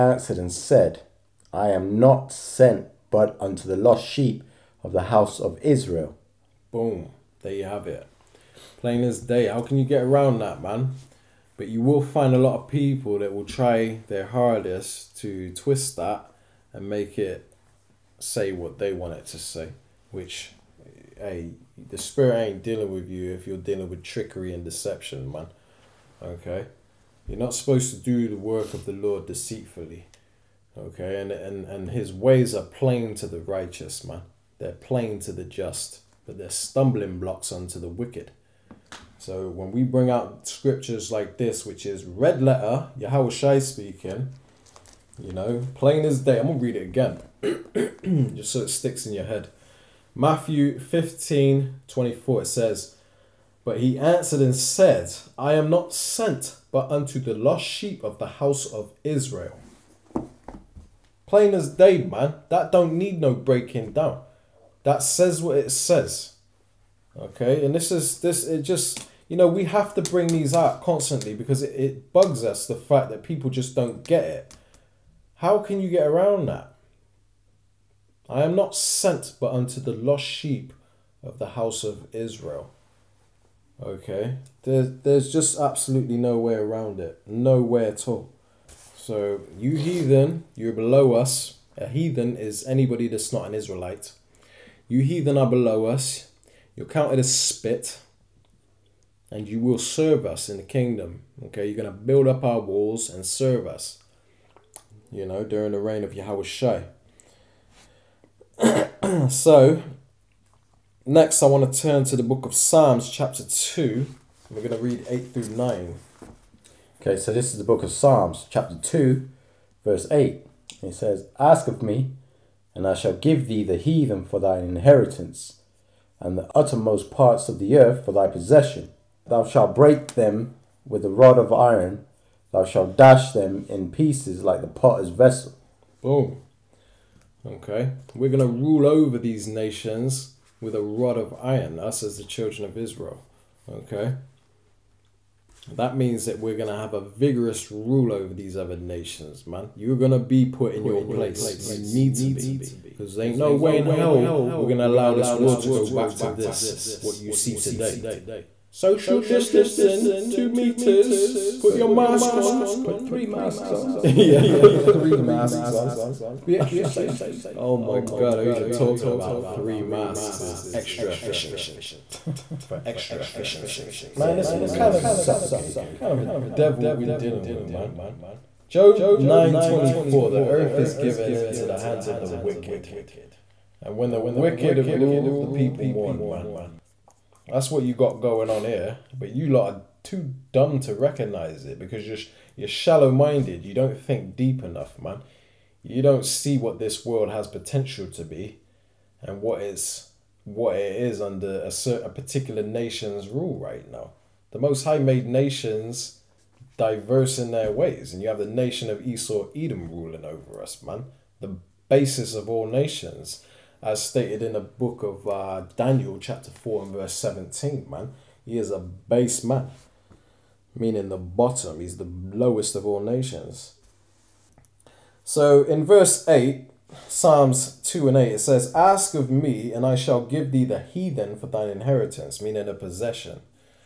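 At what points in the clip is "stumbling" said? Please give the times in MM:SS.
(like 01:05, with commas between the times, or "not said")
00:36.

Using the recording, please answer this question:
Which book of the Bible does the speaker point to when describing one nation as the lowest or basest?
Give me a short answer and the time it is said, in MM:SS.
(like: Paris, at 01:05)
Daniel, at 03:35.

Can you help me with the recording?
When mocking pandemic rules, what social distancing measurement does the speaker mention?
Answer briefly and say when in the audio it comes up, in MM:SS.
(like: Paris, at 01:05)
2 meters, at 02:40.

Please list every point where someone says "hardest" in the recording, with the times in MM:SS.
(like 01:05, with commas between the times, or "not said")
00:14.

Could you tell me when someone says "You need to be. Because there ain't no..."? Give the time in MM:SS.
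02:31.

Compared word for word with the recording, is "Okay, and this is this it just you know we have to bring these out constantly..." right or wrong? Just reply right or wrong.
right.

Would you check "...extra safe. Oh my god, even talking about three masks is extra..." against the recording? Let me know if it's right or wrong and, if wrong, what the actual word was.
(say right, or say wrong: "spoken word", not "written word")
right.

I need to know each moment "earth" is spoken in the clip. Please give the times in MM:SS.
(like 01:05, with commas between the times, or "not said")
02:07, 03:00.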